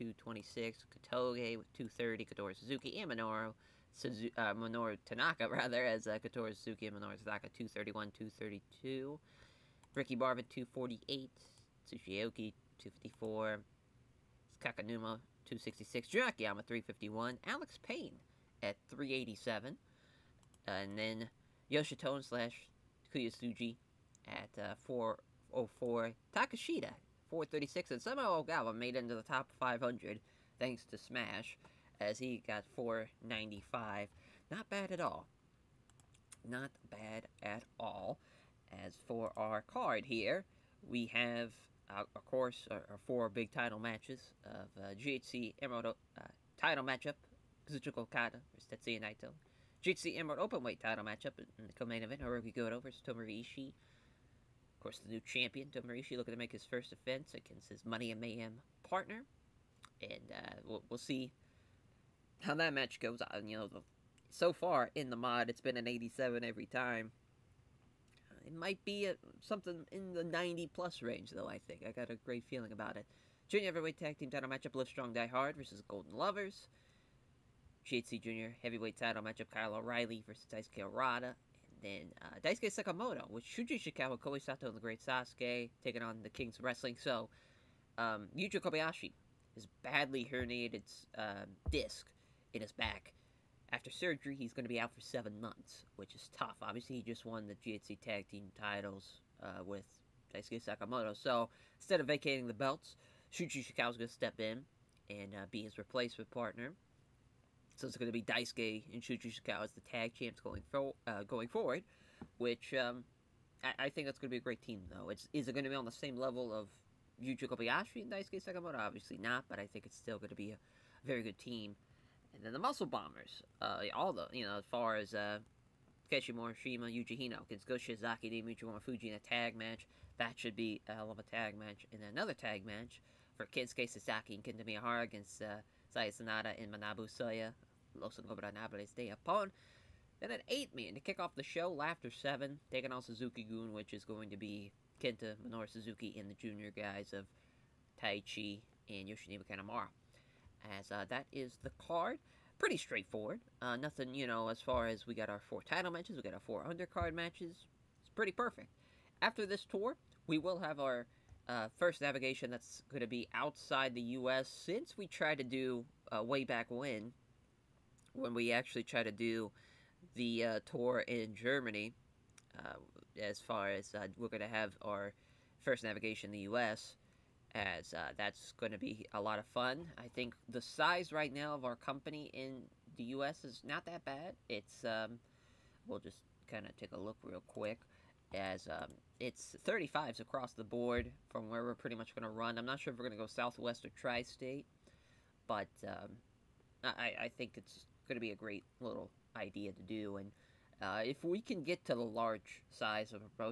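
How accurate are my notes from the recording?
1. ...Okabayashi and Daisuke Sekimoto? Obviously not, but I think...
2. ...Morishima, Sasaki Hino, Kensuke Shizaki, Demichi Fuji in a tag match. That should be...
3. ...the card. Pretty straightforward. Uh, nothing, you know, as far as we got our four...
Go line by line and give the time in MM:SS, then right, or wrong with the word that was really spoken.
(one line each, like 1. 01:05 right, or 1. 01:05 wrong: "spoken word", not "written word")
1. 01:57 right
2. 02:06 wrong: "Yuji", not "Sasaki"
3. 02:31 right.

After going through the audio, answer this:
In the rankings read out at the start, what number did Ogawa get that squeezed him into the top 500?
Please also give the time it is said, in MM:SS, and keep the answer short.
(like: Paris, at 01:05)
495, at 00:32.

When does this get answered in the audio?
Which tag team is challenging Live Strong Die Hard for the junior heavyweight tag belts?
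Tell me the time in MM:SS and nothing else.
01:15.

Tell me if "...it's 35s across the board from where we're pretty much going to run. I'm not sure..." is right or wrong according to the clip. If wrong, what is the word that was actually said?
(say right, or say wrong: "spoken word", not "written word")
right.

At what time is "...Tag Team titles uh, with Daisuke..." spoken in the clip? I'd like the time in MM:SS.
01:38.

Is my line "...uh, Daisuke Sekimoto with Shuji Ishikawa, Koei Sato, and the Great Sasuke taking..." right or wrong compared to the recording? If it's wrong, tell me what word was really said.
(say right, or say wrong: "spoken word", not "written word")
right.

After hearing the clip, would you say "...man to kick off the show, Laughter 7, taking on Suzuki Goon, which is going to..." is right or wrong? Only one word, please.
right.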